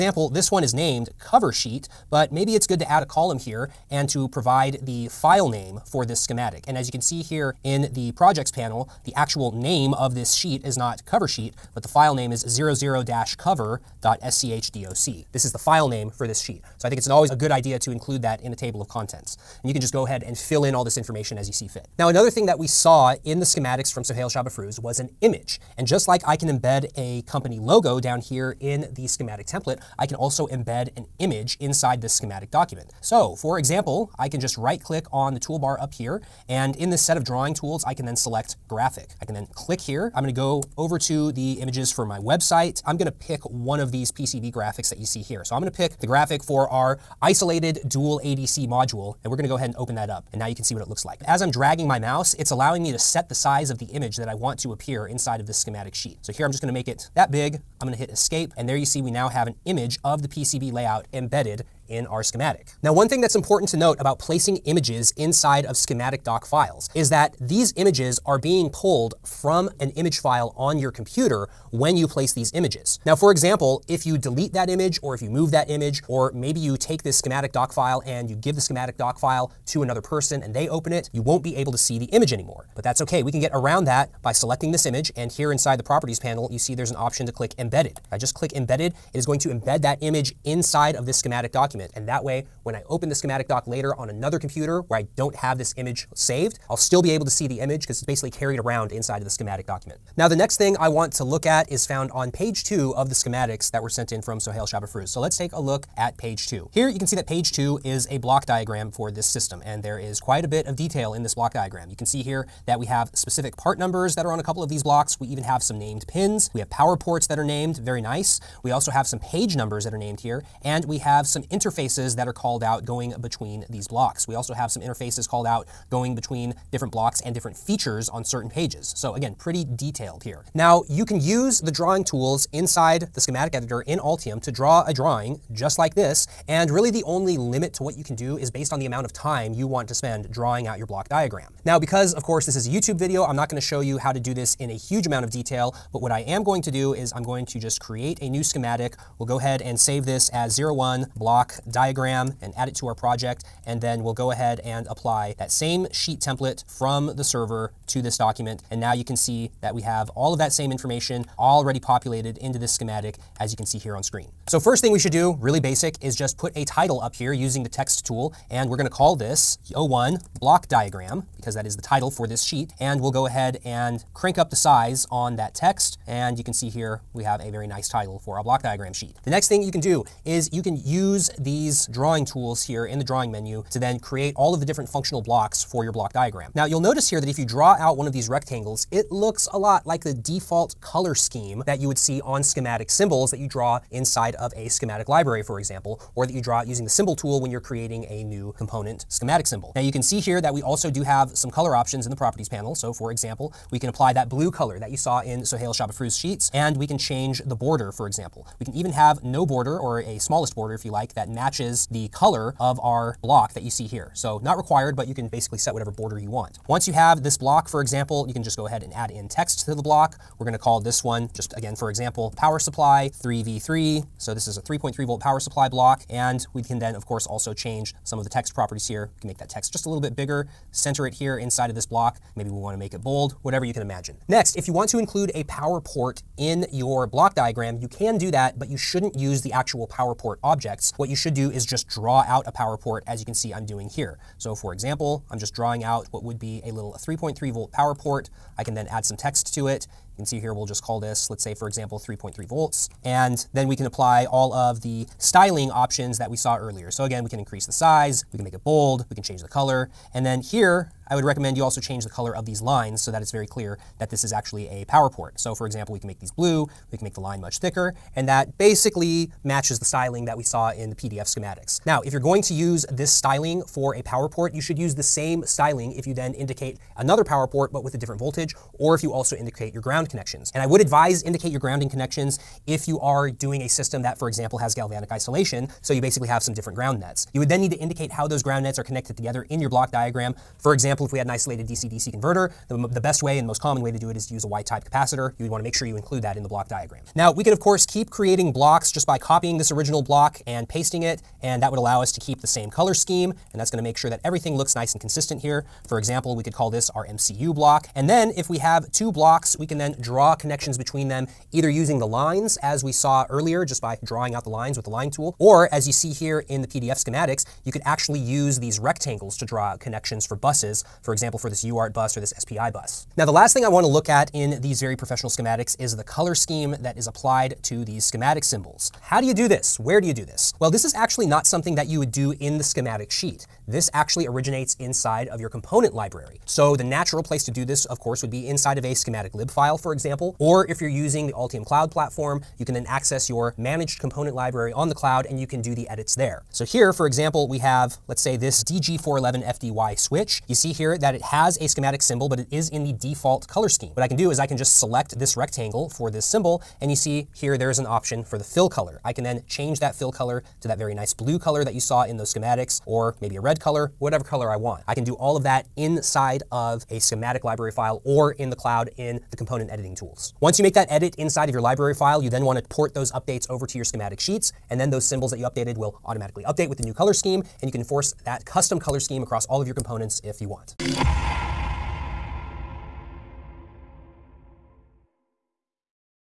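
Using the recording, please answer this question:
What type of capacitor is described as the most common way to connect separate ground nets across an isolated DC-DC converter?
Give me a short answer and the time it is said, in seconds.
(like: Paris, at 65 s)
Y-type capacitor, at 294 s.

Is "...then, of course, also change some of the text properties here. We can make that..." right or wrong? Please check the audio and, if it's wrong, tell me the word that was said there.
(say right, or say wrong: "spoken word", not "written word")
right.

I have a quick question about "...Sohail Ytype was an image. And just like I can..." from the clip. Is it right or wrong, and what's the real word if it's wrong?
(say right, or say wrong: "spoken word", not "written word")
wrong: "Shabafruz", not "Ytype".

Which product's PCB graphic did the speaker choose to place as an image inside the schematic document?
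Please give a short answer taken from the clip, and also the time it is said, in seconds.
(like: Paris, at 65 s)
isolated dual ADC module, at 47 s.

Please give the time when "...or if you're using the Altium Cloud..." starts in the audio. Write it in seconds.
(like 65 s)
340 s.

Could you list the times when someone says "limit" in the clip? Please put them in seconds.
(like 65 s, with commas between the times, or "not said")
137 s.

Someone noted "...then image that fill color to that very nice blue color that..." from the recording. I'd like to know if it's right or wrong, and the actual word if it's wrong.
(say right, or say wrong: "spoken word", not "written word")
wrong: "change", not "image".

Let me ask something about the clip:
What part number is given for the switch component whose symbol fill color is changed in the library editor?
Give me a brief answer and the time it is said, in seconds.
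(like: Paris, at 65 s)
DG411FDY, at 348 s.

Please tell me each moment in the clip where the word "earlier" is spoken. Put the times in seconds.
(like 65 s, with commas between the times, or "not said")
256 s, 313 s.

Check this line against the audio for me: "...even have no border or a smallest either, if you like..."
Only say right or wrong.
wrong.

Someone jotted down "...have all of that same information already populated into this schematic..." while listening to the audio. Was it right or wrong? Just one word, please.
right.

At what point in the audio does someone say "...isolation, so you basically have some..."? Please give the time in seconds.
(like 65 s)
285 s.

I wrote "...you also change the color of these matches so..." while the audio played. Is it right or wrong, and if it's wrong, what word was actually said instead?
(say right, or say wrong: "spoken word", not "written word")
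wrong: "lines", not "matches".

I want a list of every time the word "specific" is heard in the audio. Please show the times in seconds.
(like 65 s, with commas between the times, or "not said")
113 s.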